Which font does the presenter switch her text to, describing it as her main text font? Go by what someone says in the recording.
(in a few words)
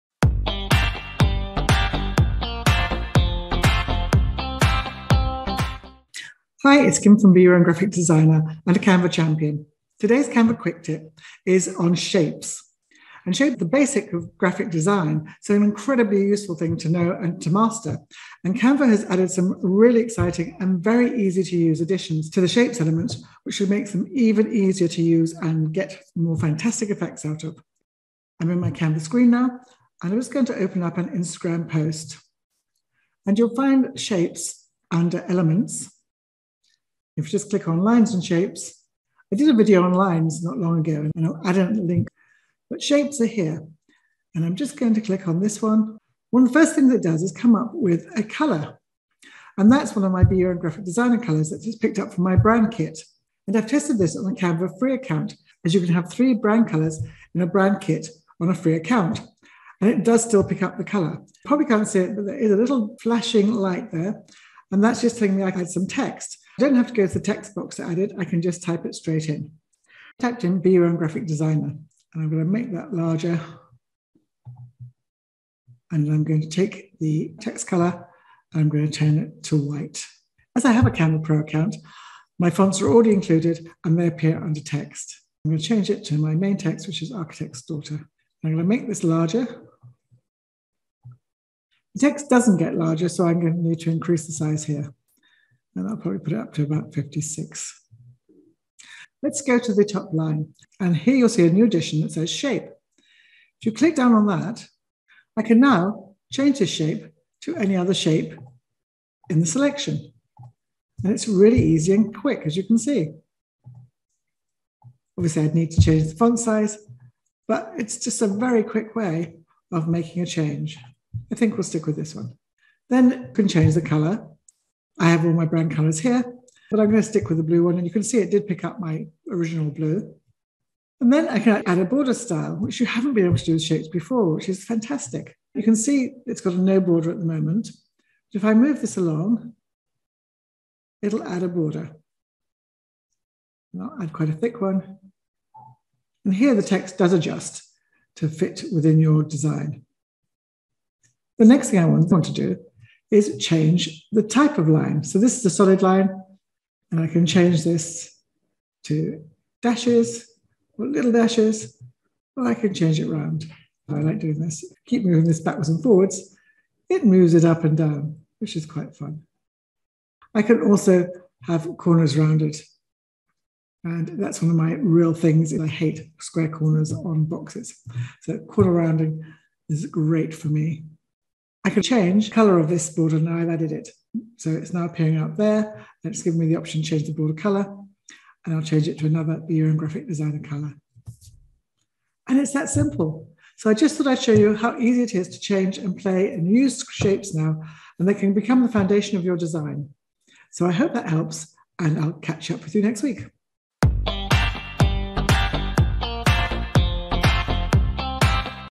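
Architect's Daughter.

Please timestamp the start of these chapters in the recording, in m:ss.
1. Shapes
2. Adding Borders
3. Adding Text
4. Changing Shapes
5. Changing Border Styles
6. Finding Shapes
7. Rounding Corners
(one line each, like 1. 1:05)
1. 0:42
2. 2:11
3. 1:02
4. 1:38
5. 2:34
6. 0:32
7. 2:53.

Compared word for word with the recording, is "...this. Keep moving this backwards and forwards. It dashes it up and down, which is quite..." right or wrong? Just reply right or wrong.
wrong.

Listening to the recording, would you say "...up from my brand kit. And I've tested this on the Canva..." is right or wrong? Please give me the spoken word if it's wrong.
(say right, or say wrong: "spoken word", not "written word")
right.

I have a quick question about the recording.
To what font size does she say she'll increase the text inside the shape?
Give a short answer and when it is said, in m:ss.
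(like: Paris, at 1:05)
56, at 1:36.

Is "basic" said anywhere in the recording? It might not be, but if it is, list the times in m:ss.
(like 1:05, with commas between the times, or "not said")
0:13.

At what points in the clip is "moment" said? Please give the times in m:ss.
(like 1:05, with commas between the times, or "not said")
2:17.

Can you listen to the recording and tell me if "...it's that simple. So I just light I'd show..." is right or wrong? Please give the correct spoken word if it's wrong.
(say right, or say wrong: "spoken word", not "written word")
wrong: "thought", not "light".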